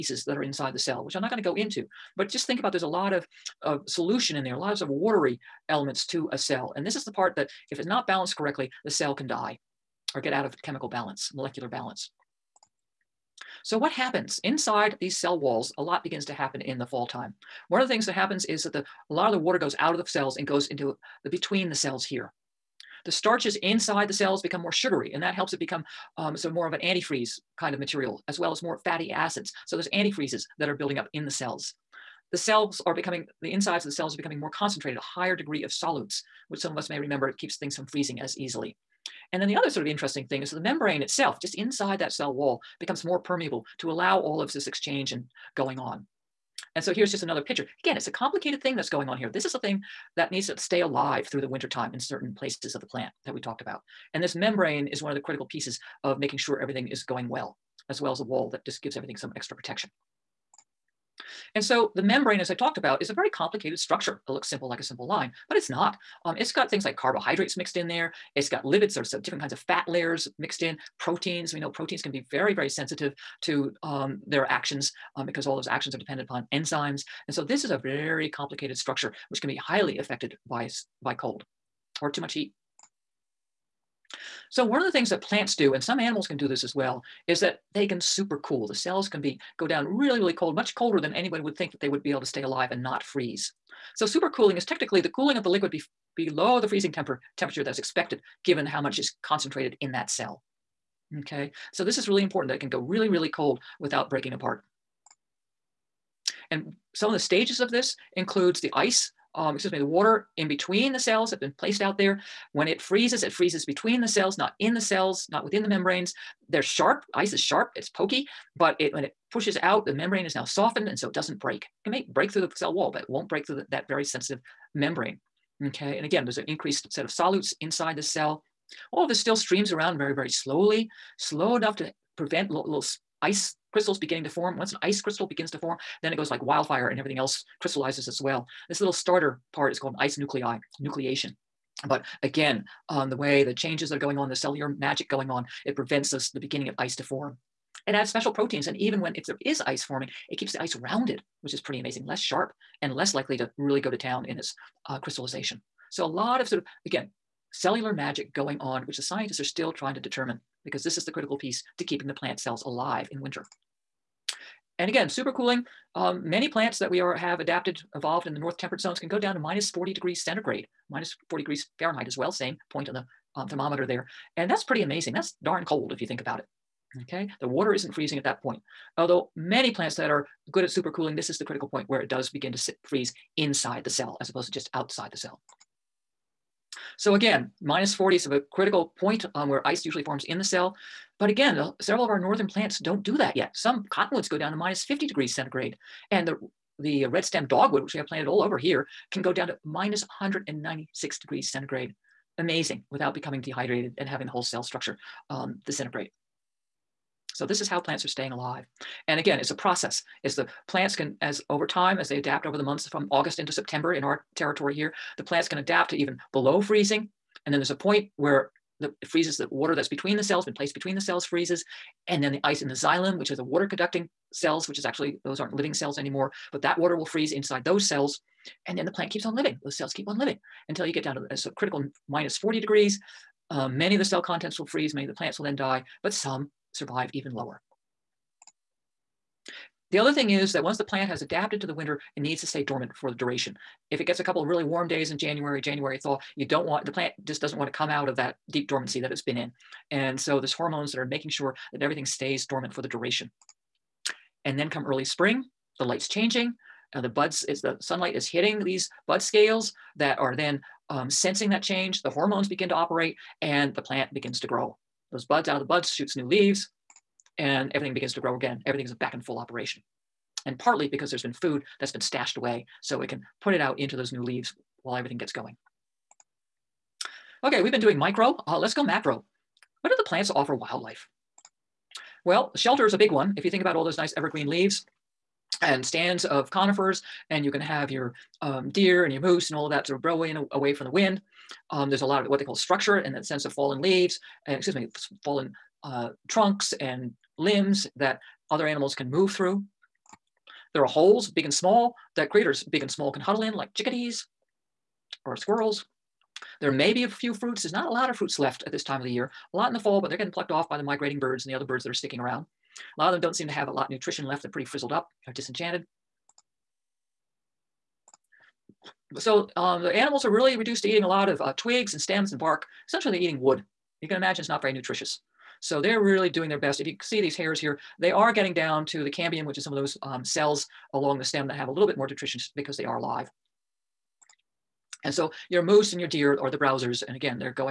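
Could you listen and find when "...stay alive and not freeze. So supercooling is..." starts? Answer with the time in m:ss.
1:32.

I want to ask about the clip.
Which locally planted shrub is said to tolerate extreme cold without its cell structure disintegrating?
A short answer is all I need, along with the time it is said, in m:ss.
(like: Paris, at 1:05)
red stem dogwood, at 3:17.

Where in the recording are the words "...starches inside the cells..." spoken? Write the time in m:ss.
0:23.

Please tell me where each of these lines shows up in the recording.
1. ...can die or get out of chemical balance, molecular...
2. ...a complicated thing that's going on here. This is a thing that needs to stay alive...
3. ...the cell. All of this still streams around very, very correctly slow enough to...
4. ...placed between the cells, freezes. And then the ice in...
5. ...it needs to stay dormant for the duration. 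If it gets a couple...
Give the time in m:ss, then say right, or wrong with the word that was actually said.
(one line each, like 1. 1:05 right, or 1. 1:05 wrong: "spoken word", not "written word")
1. 0:09 right
2. 0:48 right
3. 2:07 wrong: "slowly", not "correctly"
4. 3:40 right
5. 4:02 right.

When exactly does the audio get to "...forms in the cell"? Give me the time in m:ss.
3:10.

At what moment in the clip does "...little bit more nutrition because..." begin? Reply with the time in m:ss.
5:31.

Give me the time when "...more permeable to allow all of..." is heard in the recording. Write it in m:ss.
0:43.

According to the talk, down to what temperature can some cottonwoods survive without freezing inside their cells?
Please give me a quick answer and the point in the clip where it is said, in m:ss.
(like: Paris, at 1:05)
-50 degrees Celsius, at 3:14.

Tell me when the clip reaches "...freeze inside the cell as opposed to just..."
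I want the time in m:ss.
3:02.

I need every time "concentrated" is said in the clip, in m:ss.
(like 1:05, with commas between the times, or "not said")
0:34, 1:39.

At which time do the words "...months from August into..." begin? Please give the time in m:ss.
3:32.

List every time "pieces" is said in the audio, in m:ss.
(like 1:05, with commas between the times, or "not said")
0:55, 2:41.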